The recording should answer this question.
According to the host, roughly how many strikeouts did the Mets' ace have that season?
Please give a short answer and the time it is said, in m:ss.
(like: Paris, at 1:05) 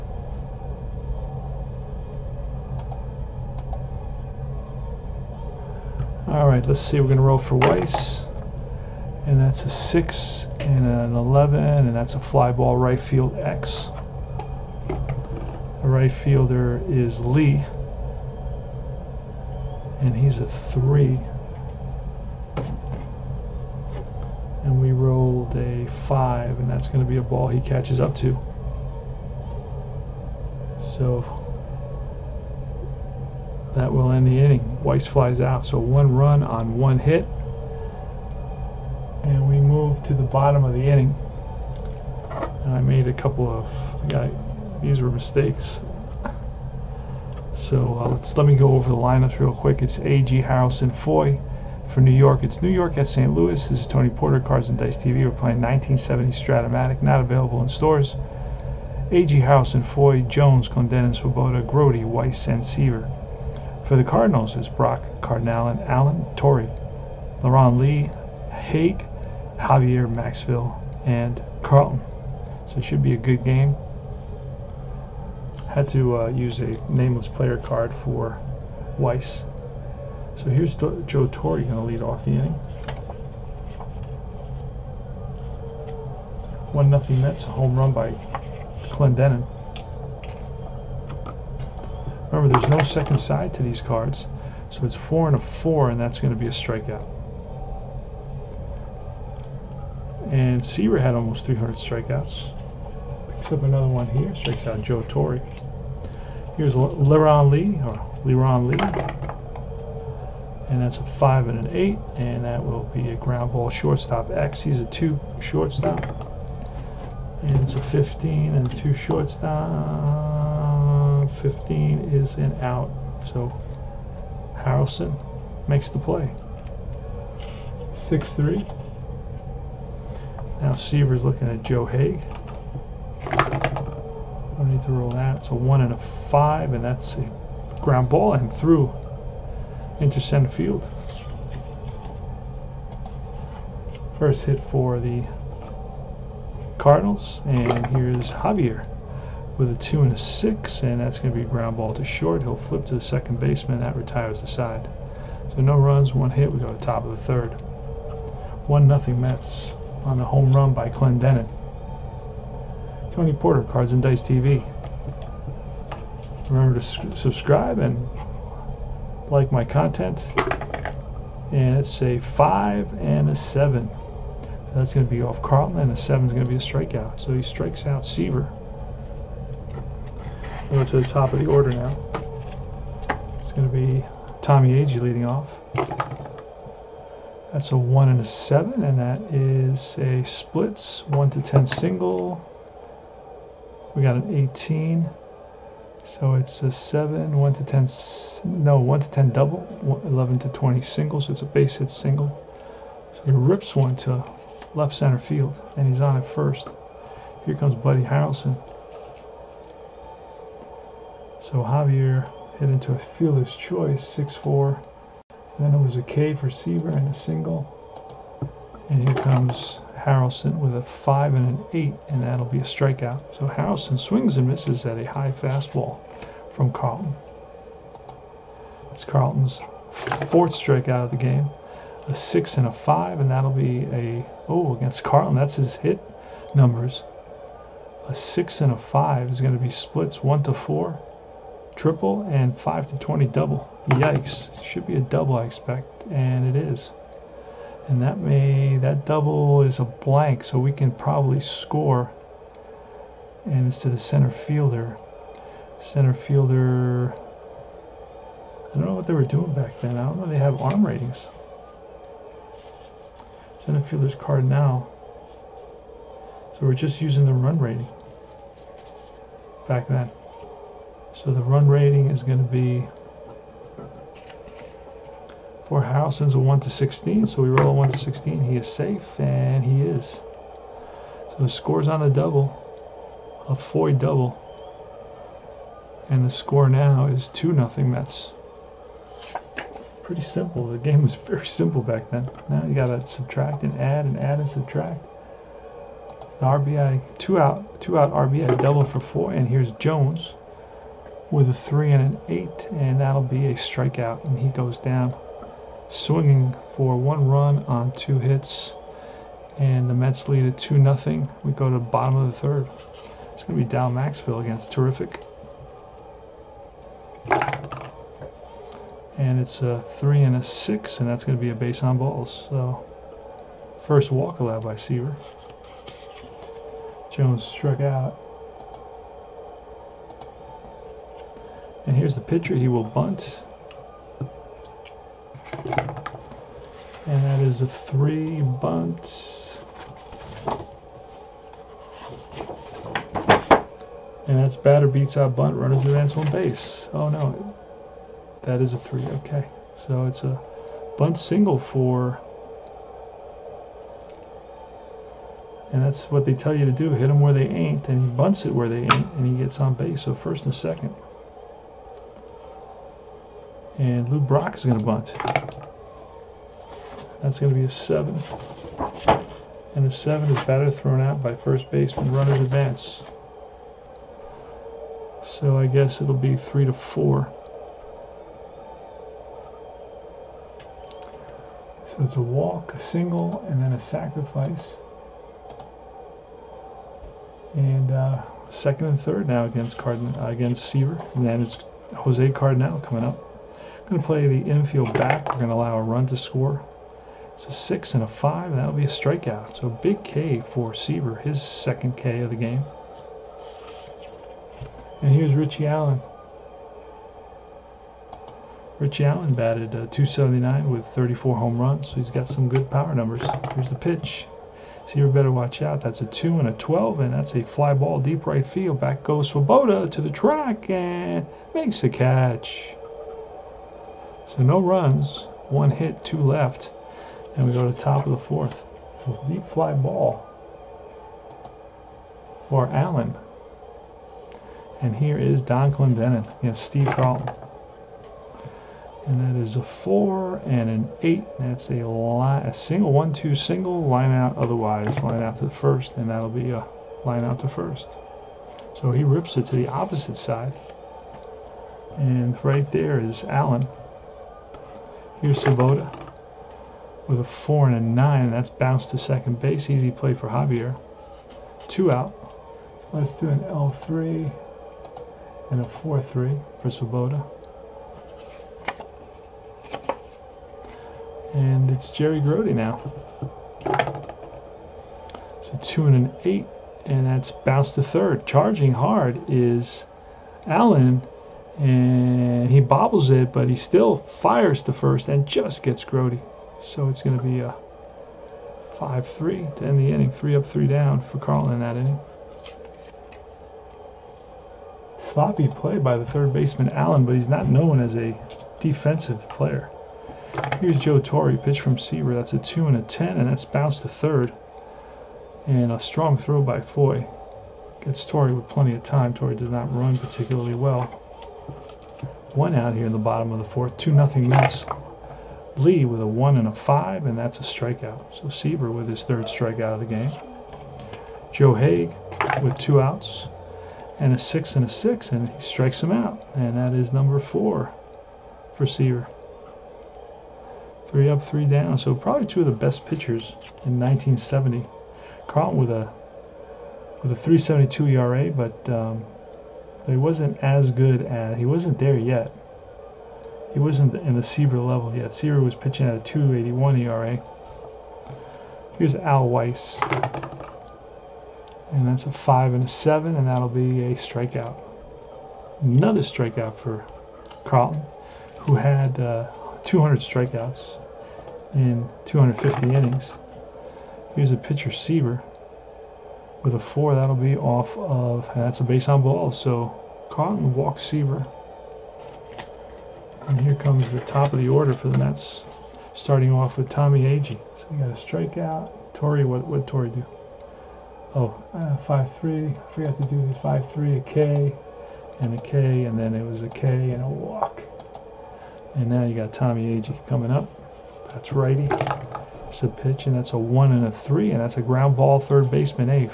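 almost 300, at 1:41.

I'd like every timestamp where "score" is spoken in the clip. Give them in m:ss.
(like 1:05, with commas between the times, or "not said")
4:11, 4:41, 4:46, 6:36.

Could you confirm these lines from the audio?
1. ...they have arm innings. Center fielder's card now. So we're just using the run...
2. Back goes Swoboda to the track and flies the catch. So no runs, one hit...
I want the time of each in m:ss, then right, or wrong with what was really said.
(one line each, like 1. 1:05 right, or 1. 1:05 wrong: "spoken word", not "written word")
1. 4:20 wrong: "ratings", not "innings"
2. 6:58 wrong: "makes", not "flies".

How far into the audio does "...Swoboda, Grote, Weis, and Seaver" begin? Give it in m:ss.
1:01.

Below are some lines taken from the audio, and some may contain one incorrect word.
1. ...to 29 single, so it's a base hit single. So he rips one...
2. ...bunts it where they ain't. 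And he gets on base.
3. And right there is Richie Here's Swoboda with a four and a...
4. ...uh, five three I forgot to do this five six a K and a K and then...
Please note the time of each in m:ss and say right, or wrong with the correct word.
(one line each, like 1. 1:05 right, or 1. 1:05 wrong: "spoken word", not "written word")
1. 3:20 wrong: "20", not "29"
2. 5:58 right
3. 7:31 wrong: "Allen", not "Richie"
4. 9:41 wrong: "three", not "six".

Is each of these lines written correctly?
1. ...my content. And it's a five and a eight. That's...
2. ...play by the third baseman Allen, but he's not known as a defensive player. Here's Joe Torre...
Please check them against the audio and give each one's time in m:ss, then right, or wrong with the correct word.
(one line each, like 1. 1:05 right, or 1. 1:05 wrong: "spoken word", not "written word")
1. 2:49 wrong: "seven", not "eight"
2. 8:15 right.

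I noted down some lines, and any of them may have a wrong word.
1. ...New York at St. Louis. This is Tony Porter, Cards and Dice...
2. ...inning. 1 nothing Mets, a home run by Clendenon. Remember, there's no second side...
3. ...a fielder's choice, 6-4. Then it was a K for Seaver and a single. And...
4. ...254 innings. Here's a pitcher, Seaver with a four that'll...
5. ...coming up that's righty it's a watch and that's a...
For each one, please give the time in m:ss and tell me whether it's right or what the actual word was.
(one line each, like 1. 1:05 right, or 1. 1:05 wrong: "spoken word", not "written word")
1. 0:52 right
2. 1:22 right
3. 3:32 right
4. 9:22 wrong: "250", not "254"
5. 9:50 wrong: "pitch", not "watch".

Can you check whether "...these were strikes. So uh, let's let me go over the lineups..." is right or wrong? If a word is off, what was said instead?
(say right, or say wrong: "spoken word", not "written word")
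wrong: "mistakes", not "strikes".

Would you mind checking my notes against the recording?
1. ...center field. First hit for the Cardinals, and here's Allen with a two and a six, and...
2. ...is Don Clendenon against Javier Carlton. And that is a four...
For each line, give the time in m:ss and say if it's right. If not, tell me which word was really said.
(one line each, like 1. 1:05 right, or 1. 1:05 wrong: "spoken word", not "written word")
1. 2:20 wrong: "Javier", not "Allen"
2. 7:15 wrong: "Steve", not "Javier".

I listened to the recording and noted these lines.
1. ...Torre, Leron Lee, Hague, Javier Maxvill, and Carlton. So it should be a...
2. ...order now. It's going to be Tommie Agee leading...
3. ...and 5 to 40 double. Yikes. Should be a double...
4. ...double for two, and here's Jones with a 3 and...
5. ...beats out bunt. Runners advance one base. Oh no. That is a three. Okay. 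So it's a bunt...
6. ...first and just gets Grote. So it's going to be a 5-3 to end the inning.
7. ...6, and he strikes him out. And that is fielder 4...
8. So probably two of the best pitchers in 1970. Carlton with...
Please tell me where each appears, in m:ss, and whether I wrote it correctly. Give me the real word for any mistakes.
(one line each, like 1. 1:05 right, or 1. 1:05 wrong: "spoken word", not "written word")
1. 1:06 right
2. 3:01 right
3. 4:02 wrong: "20", not "40"
4. 4:58 wrong: "four", not "two"
5. 5:44 right
6. 8:04 right
7. 8:44 wrong: "number", not "fielder"
8. 8:51 right.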